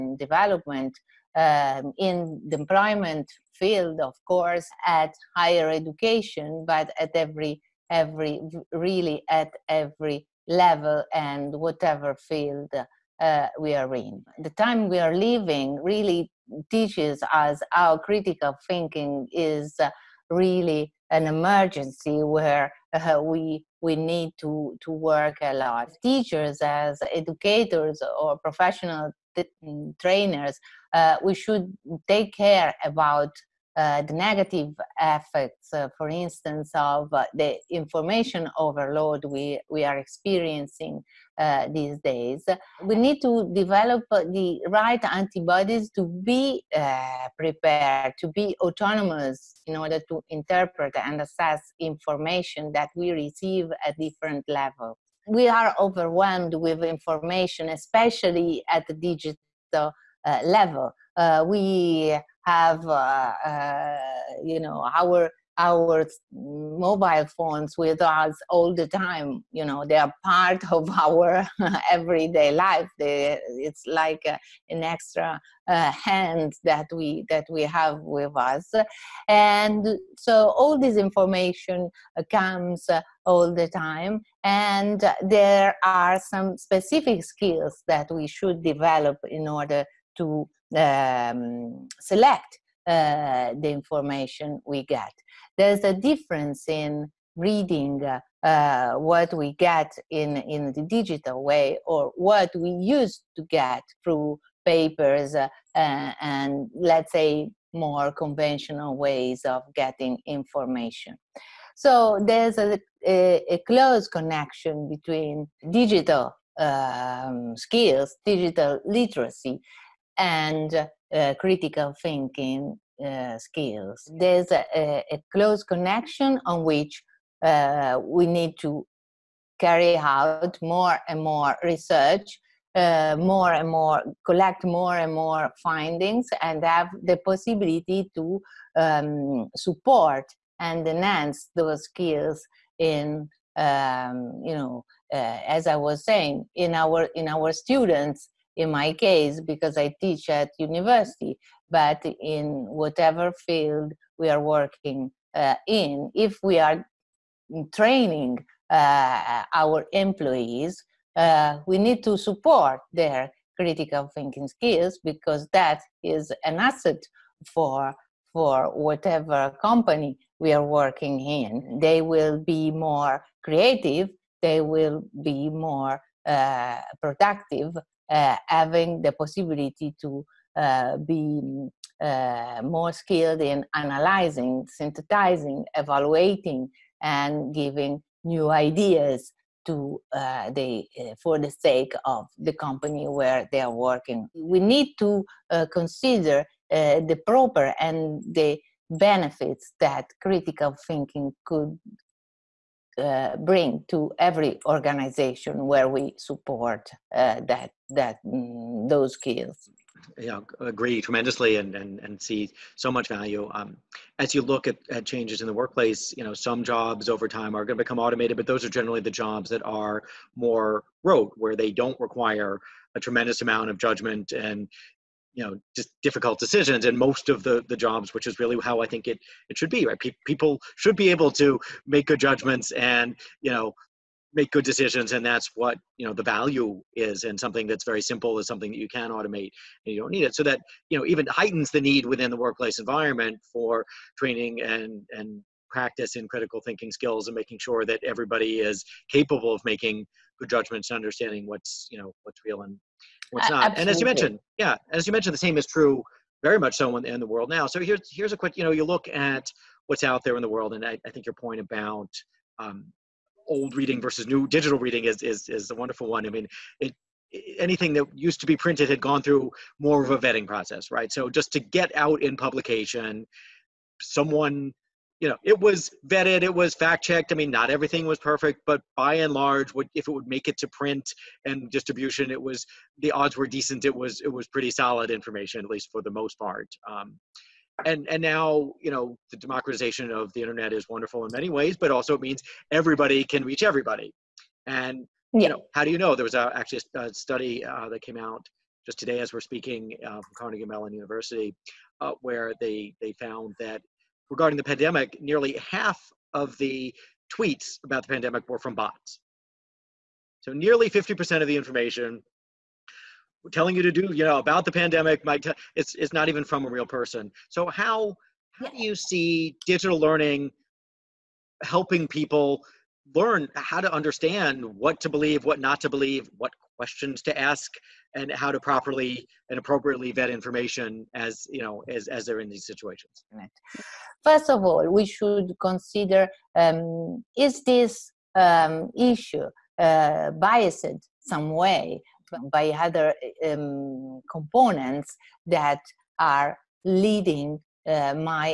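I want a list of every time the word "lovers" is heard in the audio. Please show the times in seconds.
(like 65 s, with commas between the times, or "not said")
not said.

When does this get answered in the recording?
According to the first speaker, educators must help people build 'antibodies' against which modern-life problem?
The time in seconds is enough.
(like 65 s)
37 s.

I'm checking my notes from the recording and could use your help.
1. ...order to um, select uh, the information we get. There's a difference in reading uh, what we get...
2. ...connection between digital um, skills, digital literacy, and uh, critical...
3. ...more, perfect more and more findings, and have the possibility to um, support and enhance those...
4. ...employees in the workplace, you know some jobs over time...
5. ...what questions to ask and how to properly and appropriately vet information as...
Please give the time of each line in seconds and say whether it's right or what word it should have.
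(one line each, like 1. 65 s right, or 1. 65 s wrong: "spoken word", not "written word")
1. 89 s right
2. 114 s right
3. 133 s wrong: "collect", not "perfect"
4. 215 s wrong: "changes", not "employees"
5. 326 s right.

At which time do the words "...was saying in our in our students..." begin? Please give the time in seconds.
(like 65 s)
145 s.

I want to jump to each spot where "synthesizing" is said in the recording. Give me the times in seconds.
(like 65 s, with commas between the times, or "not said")
184 s.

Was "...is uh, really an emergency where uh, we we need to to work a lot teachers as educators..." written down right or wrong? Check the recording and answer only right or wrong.
right.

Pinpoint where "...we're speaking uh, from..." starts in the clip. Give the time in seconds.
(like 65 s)
299 s.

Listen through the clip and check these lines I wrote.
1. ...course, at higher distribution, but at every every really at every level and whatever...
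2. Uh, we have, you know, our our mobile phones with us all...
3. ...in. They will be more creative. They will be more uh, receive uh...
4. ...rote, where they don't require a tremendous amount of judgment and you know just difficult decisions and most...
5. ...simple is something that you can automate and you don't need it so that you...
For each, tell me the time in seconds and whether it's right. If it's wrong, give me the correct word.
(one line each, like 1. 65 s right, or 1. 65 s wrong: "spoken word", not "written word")
1. 4 s wrong: "education", not "distribution"
2. 61 s right
3. 171 s wrong: "productive", not "receive"
4. 221 s right
5. 238 s right.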